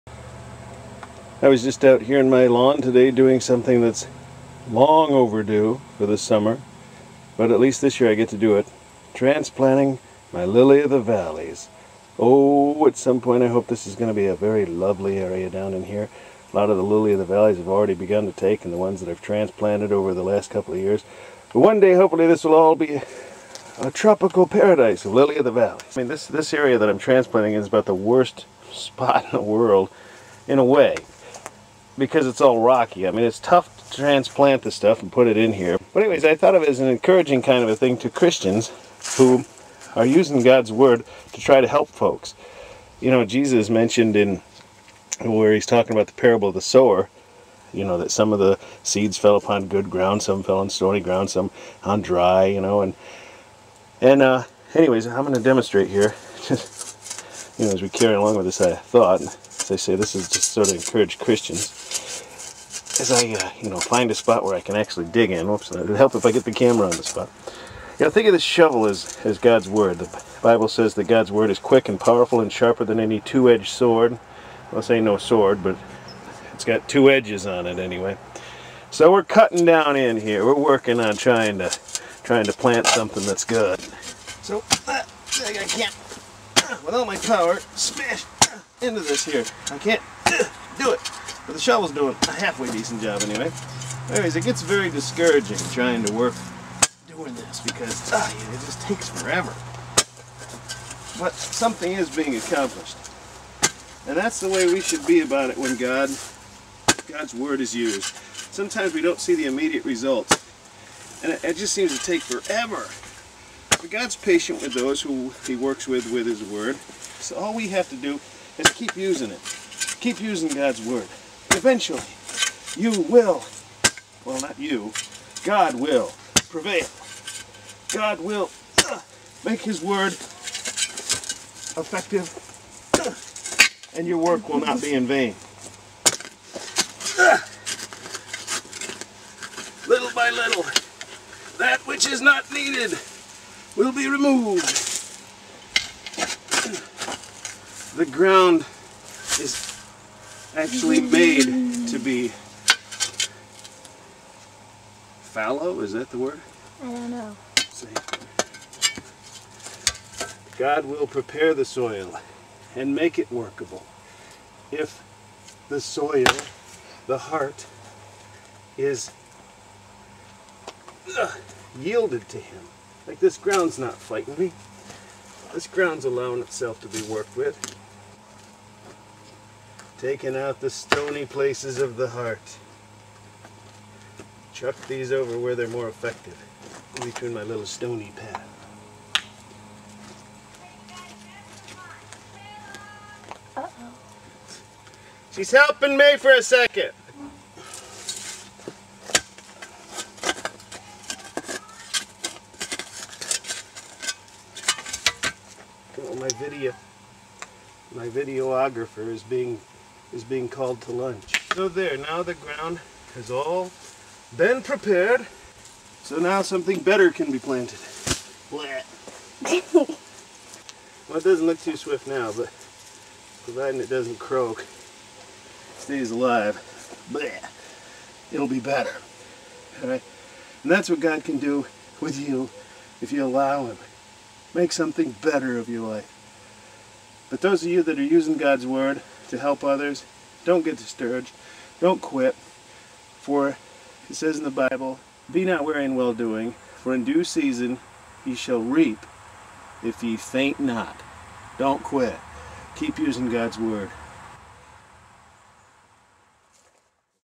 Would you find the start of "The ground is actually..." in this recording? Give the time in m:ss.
2:27.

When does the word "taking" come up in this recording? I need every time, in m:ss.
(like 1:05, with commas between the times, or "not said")
3:00.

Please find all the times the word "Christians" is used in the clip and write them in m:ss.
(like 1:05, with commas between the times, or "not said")
0:38, 1:01.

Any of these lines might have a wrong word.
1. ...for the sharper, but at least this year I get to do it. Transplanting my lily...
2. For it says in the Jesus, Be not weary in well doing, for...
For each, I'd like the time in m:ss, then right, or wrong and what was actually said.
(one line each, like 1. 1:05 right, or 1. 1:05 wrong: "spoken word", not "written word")
1. 0:05 wrong: "summer", not "sharper"
2. 4:03 wrong: "Bible", not "Jesus".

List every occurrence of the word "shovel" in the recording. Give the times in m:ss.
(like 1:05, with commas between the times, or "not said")
1:08, 1:31.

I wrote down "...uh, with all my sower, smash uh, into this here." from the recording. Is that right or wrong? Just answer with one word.
wrong.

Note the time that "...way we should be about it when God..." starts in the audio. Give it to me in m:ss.
1:44.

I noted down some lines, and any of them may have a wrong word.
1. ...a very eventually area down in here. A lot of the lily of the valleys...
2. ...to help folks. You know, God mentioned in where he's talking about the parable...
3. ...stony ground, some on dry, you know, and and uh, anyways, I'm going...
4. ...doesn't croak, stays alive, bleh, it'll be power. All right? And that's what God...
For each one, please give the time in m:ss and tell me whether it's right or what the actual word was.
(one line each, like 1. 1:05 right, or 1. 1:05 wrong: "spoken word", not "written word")
1. 0:14 wrong: "lovely", not "eventually"
2. 0:41 wrong: "Jesus", not "God"
3. 0:50 right
4. 3:43 wrong: "better", not "power".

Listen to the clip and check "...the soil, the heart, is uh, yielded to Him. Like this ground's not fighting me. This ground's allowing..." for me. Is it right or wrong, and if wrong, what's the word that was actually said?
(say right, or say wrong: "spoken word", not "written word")
right.